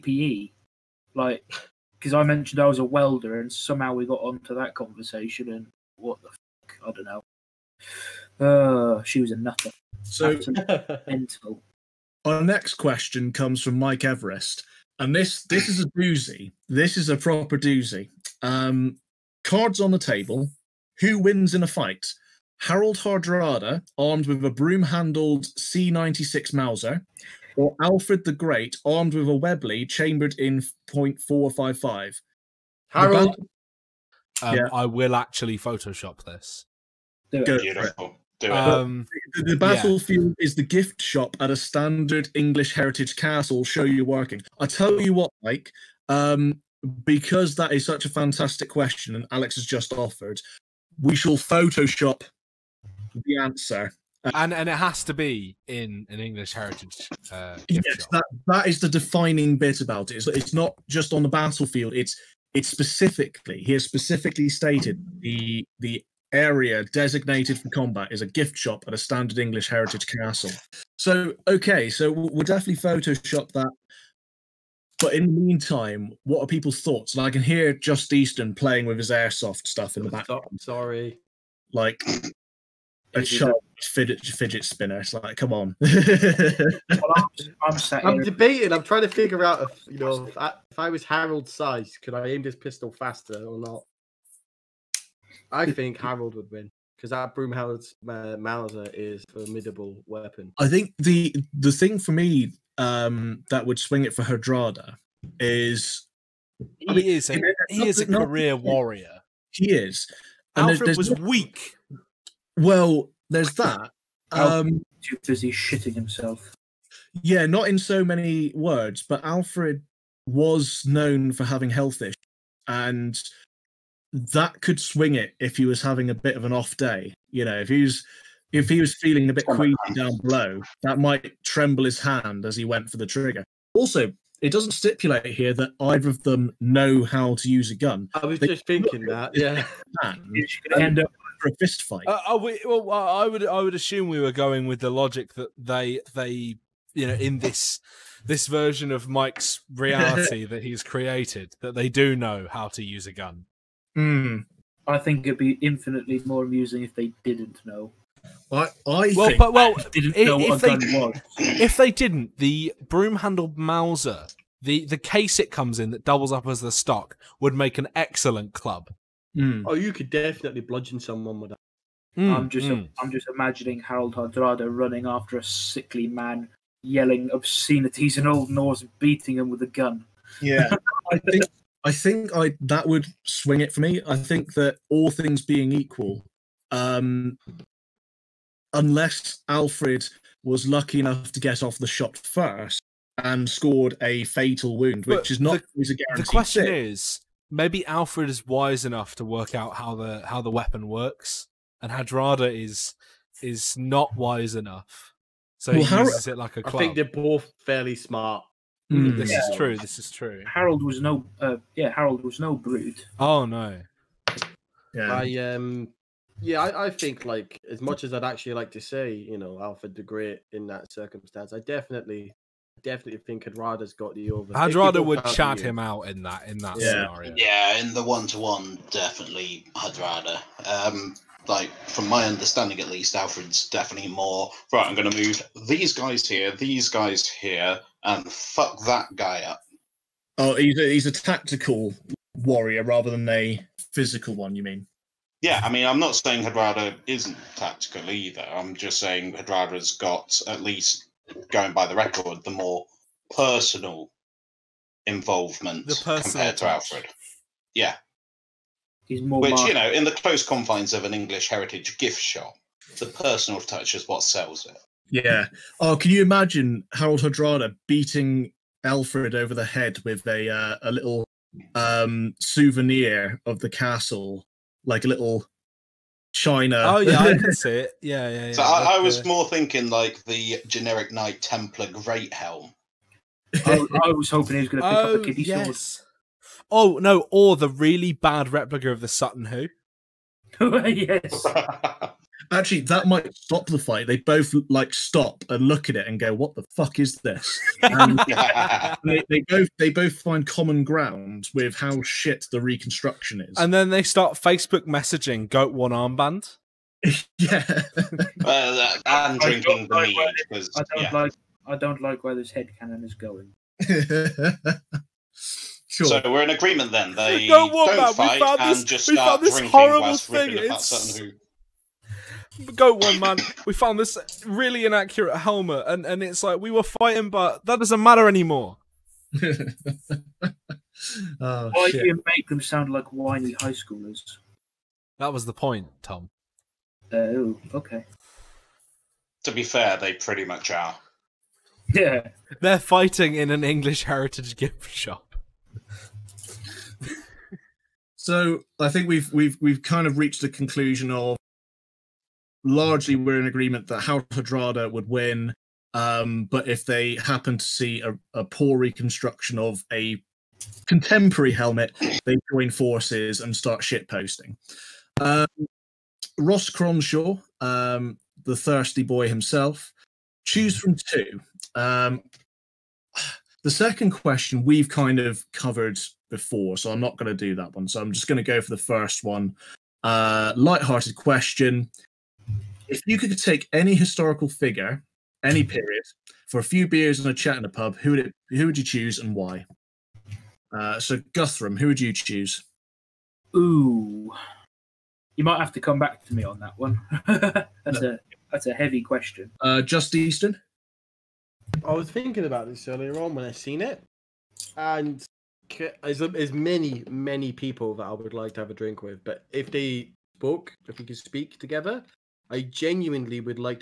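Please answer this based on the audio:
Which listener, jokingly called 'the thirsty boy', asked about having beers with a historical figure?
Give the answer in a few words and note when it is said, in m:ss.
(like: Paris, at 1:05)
Ross Cronshaw, at 6:06.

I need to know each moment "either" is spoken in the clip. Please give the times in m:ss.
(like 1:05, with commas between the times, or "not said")
2:15, 4:08.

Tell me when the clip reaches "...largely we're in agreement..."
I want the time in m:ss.
5:52.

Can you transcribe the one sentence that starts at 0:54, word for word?
Um, and and it has to be in an English heritage.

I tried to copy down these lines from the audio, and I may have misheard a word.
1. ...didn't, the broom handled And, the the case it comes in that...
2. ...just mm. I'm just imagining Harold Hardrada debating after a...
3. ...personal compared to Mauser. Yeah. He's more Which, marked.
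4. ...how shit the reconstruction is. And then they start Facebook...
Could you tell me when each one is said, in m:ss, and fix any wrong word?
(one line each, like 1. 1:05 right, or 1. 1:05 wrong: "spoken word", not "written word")
1. 2:41 wrong: "Mauser", not "And"
2. 2:52 wrong: "running", not "debating"
3. 4:15 wrong: "Alfred", not "Mauser"
4. 5:01 right.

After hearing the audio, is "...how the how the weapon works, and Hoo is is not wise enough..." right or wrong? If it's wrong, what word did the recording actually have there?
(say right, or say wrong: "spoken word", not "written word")
wrong: "Hardrada", not "Hoo".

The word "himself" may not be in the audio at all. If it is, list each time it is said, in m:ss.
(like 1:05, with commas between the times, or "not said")
1:55, 6:09.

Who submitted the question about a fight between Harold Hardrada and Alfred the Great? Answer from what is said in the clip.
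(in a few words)
Mike Everest.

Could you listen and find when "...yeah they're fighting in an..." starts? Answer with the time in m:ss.
5:41.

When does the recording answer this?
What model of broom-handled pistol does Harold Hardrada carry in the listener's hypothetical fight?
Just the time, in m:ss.
0:25.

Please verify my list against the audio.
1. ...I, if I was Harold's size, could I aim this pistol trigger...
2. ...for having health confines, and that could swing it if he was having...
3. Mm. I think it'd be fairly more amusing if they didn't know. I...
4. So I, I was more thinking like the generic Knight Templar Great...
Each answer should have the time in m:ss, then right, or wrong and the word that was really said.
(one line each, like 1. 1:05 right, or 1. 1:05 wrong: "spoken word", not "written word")
1. 1:30 wrong: "faster", not "trigger"
2. 2:01 wrong: "issues", not "confines"
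3. 2:33 wrong: "infinitely", not "fairly"
4. 4:38 right.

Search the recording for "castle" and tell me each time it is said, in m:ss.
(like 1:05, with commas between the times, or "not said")
0:43, 1:10, 4:33.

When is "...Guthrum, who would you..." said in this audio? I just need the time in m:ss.
6:31.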